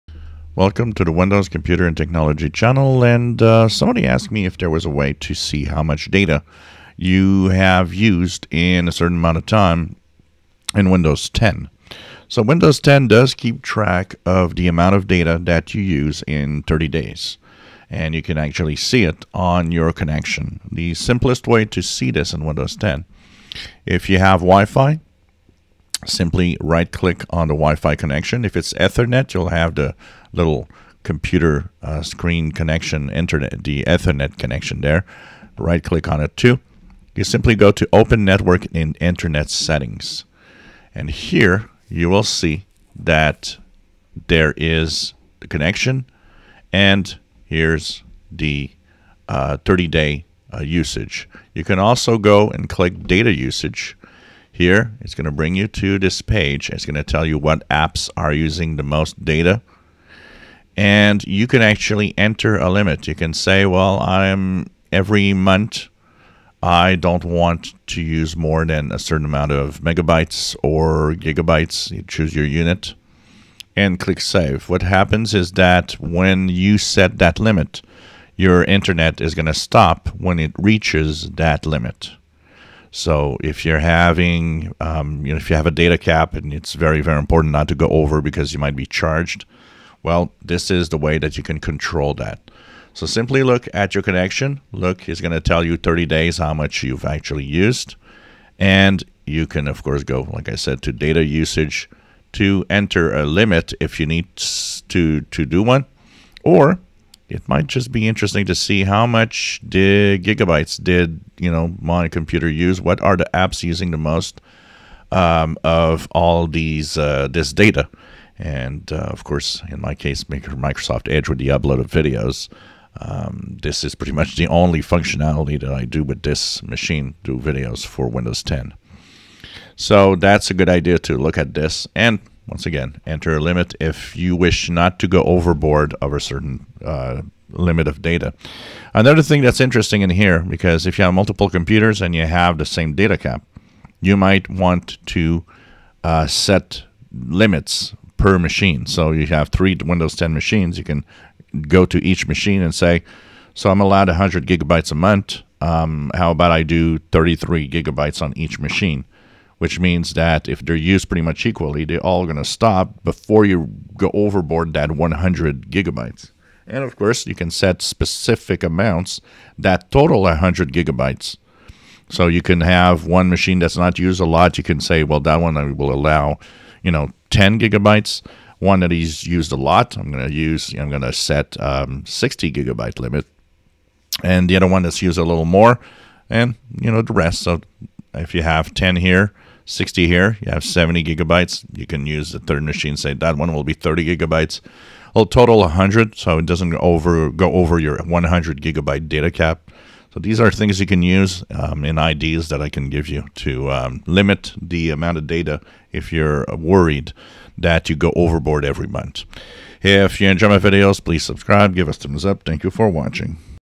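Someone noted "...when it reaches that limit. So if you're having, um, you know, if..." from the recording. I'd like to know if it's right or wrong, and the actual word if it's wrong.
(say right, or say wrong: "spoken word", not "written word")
right.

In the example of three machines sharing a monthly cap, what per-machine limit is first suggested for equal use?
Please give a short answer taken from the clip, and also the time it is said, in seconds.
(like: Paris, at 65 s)
33 gigabytes, at 157 s.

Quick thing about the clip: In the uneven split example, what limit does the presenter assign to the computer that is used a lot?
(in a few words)
60 gigabytes.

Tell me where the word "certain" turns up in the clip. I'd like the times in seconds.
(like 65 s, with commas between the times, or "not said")
8 s, 68 s, 136 s.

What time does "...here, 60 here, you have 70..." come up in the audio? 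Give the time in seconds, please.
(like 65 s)
188 s.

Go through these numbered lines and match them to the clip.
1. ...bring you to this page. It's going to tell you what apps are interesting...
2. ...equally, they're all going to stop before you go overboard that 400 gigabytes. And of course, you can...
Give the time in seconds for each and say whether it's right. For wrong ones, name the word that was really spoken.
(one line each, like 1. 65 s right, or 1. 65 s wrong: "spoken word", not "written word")
1. 55 s wrong: "using", not "interesting"
2. 161 s wrong: "100", not "400".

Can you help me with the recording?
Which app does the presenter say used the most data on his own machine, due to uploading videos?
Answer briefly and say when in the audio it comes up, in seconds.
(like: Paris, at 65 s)
Microsoft Edge, at 120 s.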